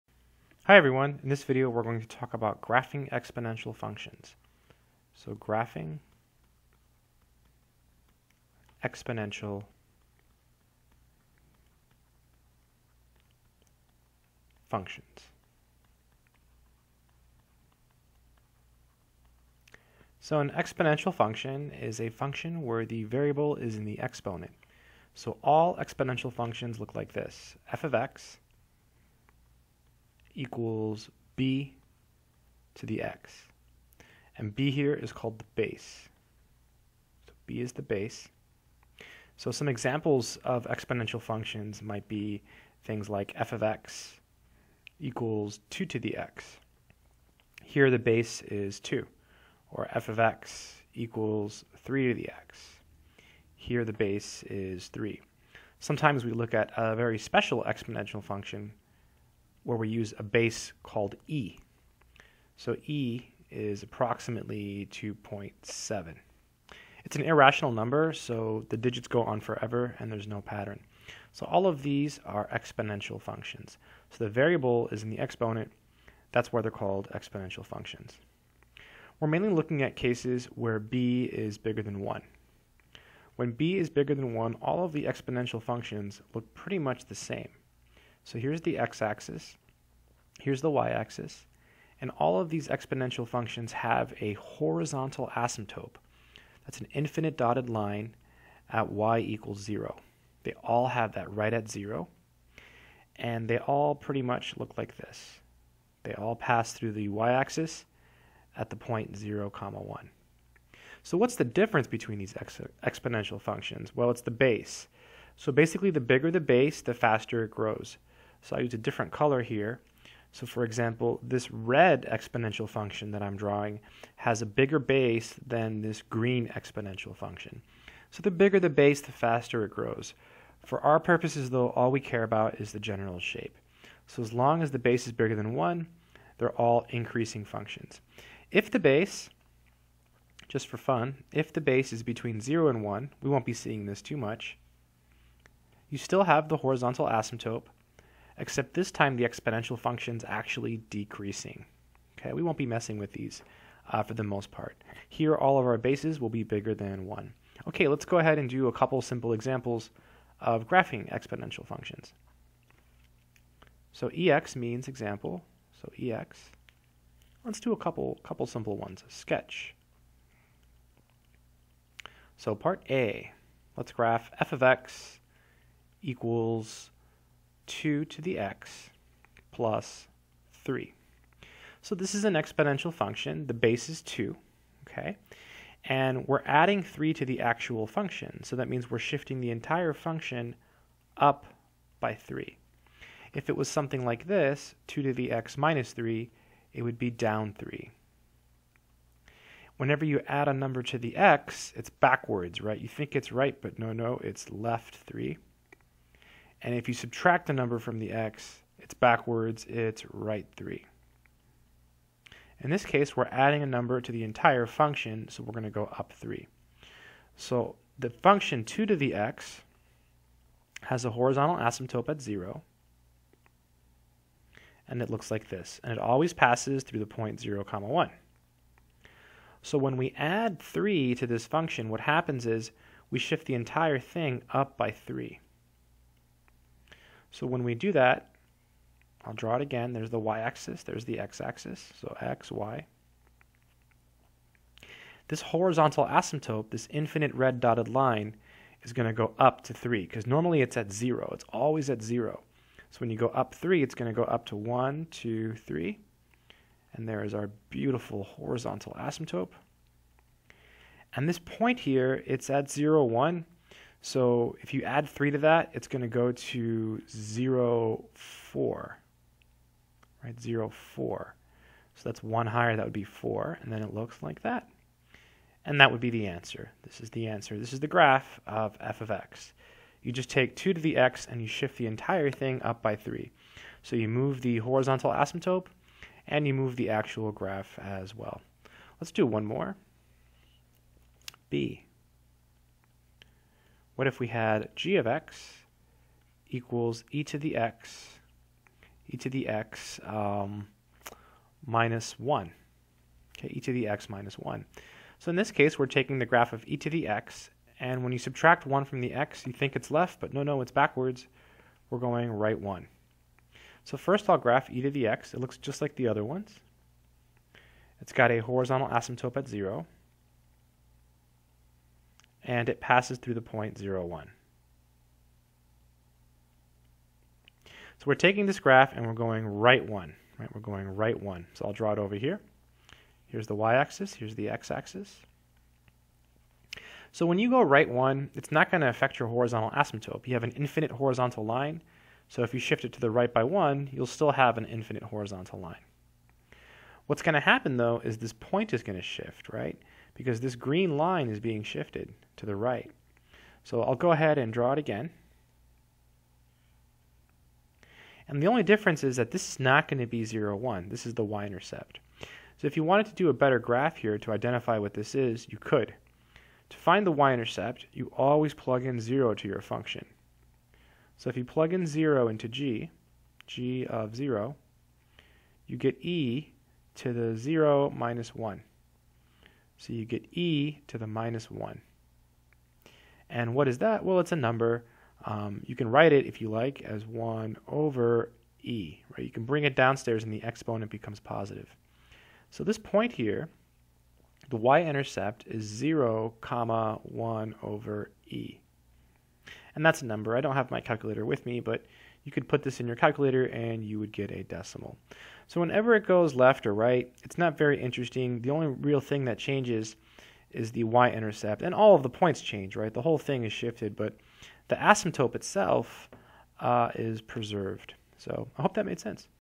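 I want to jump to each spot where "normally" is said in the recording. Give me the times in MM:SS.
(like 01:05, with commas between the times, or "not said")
04:10.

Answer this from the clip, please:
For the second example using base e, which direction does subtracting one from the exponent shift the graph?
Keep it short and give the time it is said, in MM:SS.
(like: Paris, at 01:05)
right 1, at 05:12.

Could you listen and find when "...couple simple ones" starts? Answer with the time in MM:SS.
02:48.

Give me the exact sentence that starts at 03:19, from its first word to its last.
Whenever you add a number to the x, it's backwards, right?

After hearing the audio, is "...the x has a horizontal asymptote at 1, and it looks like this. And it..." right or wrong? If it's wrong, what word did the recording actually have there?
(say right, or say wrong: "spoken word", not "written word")
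wrong: "0", not "1".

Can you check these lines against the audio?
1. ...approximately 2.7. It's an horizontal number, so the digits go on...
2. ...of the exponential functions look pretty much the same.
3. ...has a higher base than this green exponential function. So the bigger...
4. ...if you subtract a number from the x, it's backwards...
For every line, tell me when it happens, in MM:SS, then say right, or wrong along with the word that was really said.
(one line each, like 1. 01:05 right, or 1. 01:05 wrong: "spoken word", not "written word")
1. 01:03 wrong: "irrational", not "horizontal"
2. 01:24 right
3. 02:04 wrong: "bigger", not "higher"
4. 03:26 right.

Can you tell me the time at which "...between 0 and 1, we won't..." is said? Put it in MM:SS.
02:22.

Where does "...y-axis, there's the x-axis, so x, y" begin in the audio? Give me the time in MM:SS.
04:00.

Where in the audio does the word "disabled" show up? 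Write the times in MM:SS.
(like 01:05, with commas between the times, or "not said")
not said.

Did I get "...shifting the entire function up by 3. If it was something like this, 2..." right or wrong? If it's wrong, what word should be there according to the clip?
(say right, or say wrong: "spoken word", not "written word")
right.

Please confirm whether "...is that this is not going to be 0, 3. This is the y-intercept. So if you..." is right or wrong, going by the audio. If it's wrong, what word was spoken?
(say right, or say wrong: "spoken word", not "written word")
wrong: "1", not "3".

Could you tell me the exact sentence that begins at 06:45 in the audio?
So whenever it goes left or right, it's not very interesting.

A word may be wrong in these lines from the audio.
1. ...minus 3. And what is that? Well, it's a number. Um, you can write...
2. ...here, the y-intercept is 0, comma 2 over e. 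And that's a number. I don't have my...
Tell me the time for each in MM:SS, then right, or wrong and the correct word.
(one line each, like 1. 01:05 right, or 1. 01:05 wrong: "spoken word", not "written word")
1. 06:21 wrong: "1", not "3"
2. 06:33 wrong: "1", not "2".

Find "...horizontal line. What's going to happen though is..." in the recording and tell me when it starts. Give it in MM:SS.
05:45.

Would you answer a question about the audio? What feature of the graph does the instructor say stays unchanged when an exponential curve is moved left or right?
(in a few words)
the asymptote.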